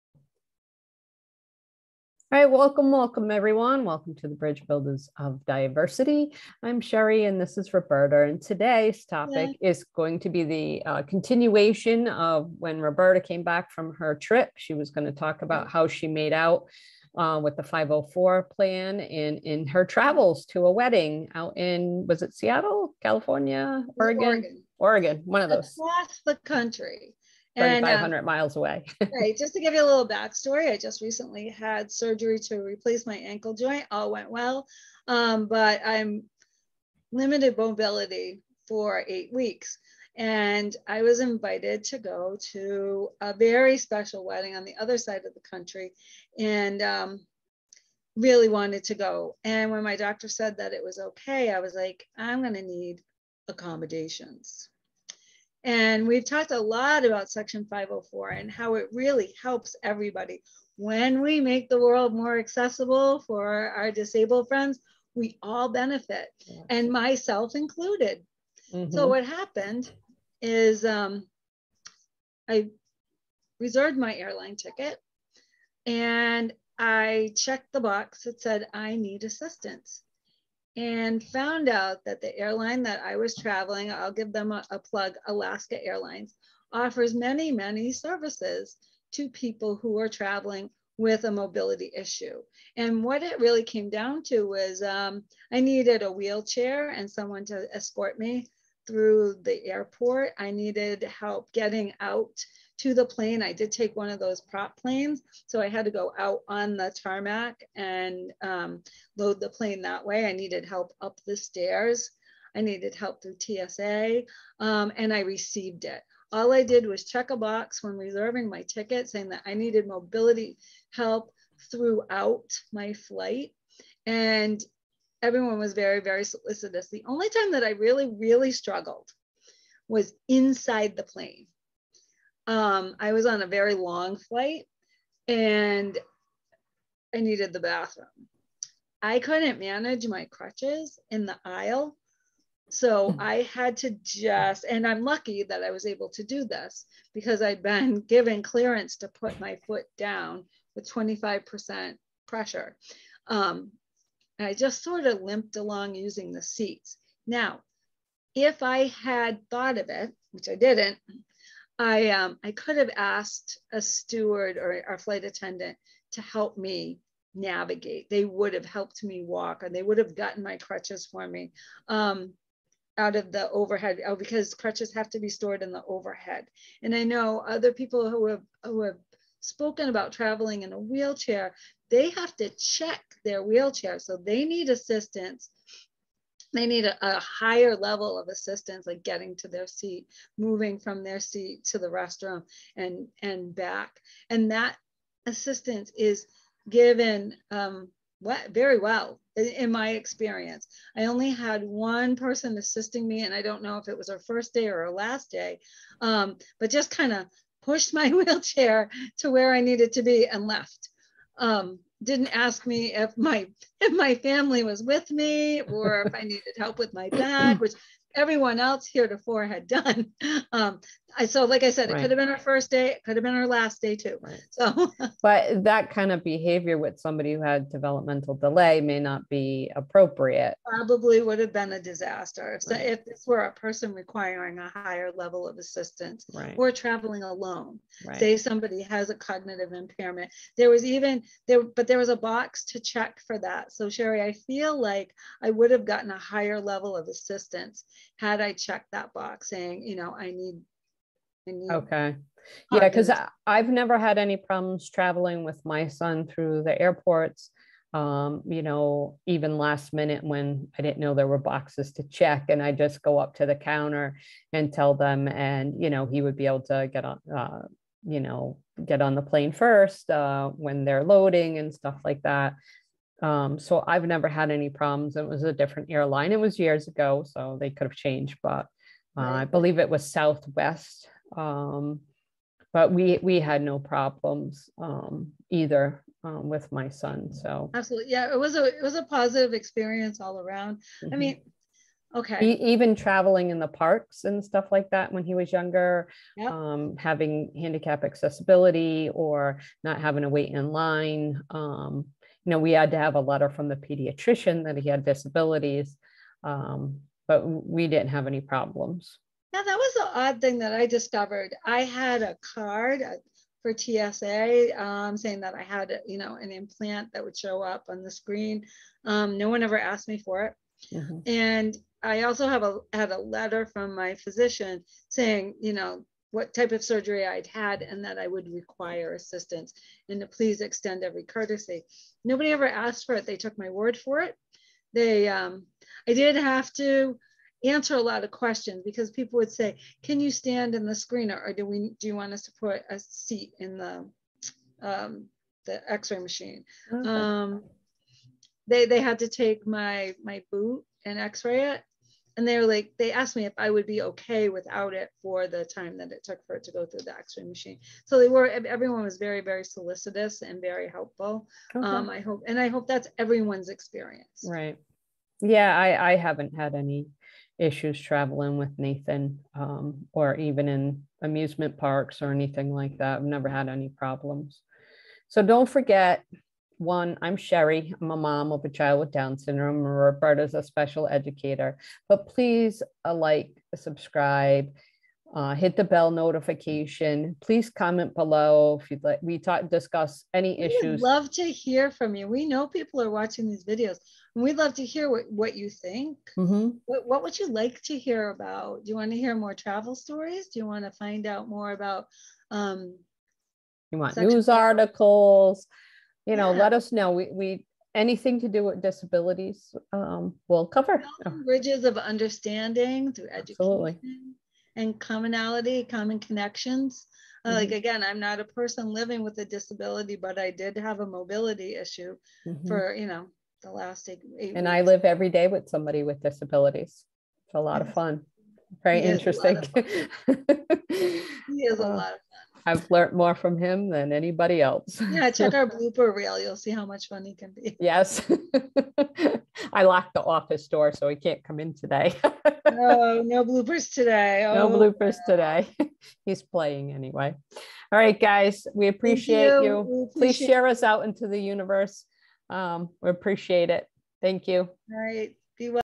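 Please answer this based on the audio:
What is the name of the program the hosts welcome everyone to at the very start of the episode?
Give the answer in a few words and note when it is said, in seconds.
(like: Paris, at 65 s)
Bridge Builders of Diversity, at 4 s.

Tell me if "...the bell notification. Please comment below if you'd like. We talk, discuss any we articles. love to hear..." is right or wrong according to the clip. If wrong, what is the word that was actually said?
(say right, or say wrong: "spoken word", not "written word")
wrong: "issues", not "articles".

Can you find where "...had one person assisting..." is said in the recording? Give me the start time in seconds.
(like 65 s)
201 s.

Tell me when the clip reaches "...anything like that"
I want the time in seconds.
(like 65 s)
372 s.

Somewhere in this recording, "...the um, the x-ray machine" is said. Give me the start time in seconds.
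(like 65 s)
343 s.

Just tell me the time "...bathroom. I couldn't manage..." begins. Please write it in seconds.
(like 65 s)
137 s.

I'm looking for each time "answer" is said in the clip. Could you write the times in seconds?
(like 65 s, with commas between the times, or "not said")
337 s.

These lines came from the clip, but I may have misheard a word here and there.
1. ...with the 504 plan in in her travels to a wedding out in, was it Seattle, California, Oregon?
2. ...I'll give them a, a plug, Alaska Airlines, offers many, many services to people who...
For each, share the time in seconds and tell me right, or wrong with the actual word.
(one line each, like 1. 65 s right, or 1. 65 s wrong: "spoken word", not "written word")
1. 17 s right
2. 83 s right.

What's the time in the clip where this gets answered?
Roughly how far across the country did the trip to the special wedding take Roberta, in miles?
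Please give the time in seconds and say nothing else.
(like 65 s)
27 s.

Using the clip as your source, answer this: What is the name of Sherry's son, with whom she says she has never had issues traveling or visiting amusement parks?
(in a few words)
Nathan.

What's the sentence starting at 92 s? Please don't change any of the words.
And what it really came down to was um, I needed a wheelchair and someone to escort me through the airport.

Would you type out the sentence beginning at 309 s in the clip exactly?
Yeah, that was the odd thing that I discovered.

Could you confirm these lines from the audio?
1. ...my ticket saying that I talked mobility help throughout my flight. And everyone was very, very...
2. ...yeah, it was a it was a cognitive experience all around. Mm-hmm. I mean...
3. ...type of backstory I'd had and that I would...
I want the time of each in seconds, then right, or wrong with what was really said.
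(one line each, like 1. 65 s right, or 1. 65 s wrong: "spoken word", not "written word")
1. 118 s wrong: "needed", not "talked"
2. 288 s wrong: "positive", not "cognitive"
3. 326 s wrong: "surgery", not "backstory".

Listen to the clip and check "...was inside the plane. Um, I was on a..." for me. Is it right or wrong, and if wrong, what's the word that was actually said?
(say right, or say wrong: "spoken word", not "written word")
right.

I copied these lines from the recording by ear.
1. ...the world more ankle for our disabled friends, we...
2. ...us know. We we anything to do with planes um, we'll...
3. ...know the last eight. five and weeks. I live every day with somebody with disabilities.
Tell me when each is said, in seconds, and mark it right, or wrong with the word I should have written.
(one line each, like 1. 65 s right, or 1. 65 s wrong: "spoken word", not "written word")
1. 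61 s wrong: "accessible", not "ankle"
2. 406 s wrong: "disabilities", not "planes"
3. 423 s wrong: "eight", not "five".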